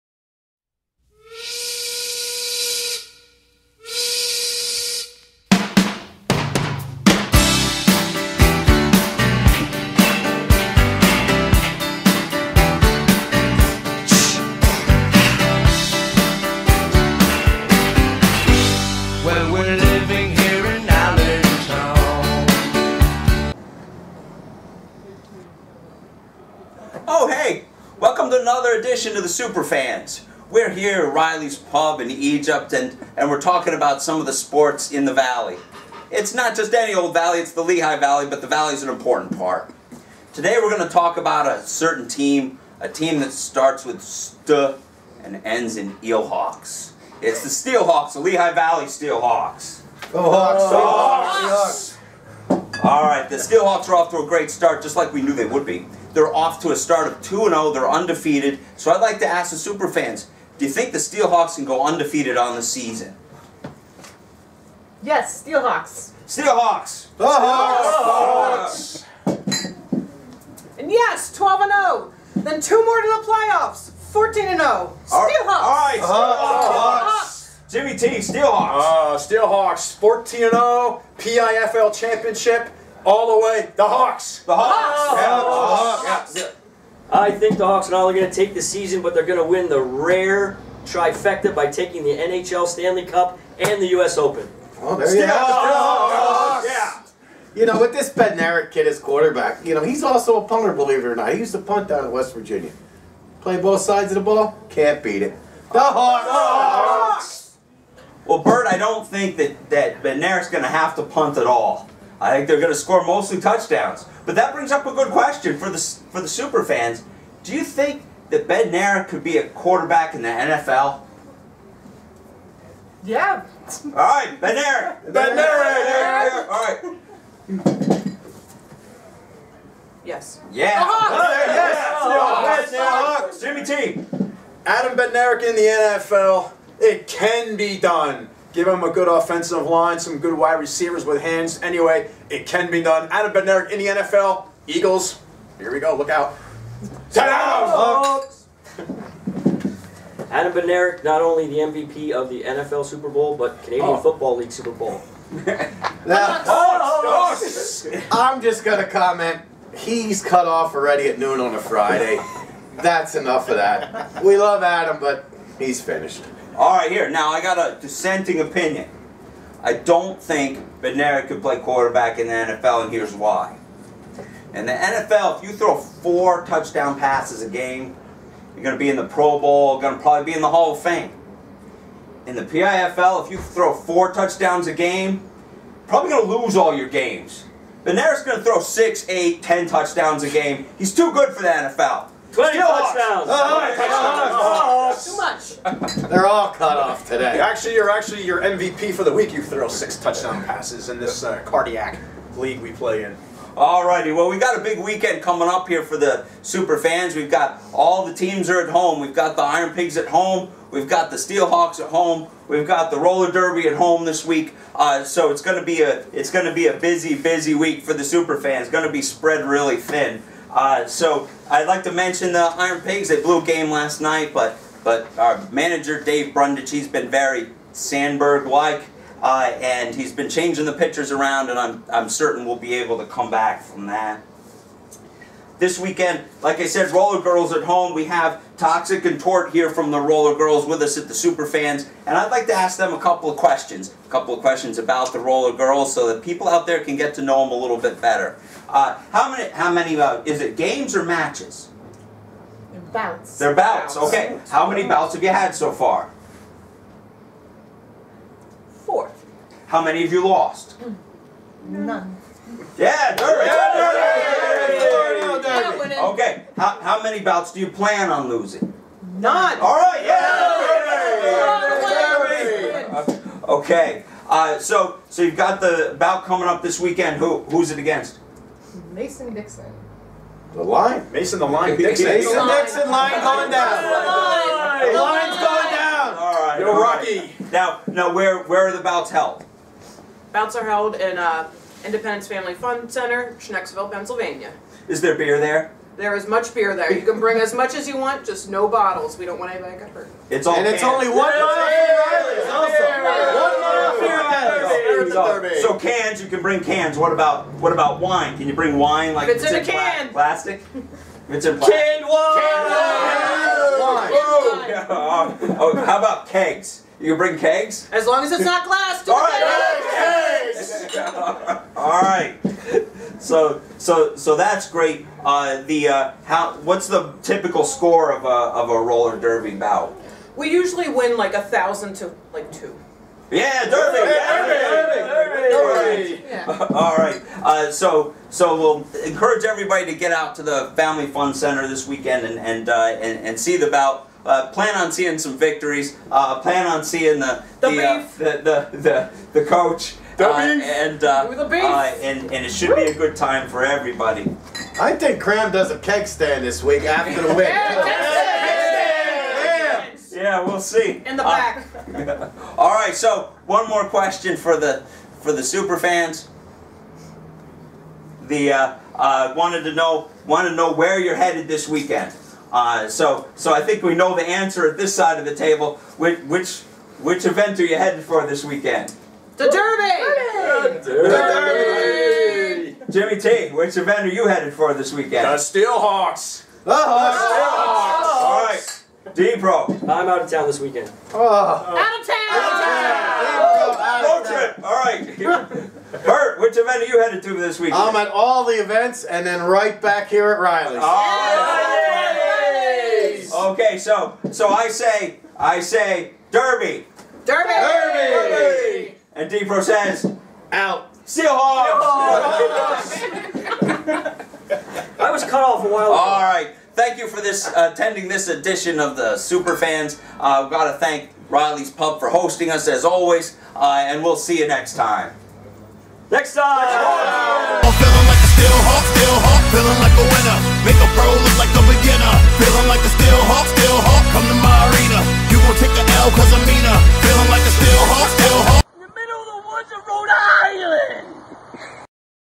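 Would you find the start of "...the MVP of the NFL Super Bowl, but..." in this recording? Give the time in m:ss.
2:31.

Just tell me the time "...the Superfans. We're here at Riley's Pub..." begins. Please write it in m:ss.
0:29.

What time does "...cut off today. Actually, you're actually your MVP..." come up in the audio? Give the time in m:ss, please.
3:16.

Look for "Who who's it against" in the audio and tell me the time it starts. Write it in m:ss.
4:37.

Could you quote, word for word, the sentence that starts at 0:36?
It's not just any old valley, it's the Lehigh Valley, but the valley is an important part.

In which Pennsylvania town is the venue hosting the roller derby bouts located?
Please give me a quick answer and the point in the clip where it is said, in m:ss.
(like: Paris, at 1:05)
Schnecksville, at 4:53.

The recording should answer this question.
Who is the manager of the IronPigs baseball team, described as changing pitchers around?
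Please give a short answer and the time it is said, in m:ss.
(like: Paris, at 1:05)
Dave Brundage, at 3:46.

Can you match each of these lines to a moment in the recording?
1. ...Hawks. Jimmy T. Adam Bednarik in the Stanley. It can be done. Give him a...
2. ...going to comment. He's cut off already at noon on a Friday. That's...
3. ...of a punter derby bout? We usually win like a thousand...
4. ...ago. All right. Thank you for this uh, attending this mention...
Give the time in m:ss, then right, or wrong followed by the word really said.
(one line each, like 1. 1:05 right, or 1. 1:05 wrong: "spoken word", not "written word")
1. 2:12 wrong: "NFL", not "Stanley"
2. 2:38 right
3. 5:28 wrong: "roller", not "punter"
4. 6:55 wrong: "edition", not "mention".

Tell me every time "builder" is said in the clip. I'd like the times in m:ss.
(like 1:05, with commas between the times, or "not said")
not said.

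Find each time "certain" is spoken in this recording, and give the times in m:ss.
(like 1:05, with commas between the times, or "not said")
0:41, 3:52.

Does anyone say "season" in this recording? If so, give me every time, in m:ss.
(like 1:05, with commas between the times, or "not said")
1:02, 1:28.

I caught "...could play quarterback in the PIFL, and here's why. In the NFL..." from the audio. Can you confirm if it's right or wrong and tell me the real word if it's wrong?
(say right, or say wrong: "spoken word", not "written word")
wrong: "NFL", not "PIFL".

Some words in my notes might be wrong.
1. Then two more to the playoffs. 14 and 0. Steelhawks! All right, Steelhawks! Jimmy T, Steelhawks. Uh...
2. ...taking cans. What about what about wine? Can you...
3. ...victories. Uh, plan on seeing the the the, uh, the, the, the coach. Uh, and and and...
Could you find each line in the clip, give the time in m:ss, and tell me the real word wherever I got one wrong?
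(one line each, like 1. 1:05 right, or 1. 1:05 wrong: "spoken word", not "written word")
1. 1:12 right
2. 5:06 wrong: "bring", not "taking"
3. 5:45 right.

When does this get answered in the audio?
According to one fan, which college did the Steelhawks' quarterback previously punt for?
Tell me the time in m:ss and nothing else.
1:42.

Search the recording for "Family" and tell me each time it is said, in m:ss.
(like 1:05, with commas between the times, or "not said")
4:52, 5:40.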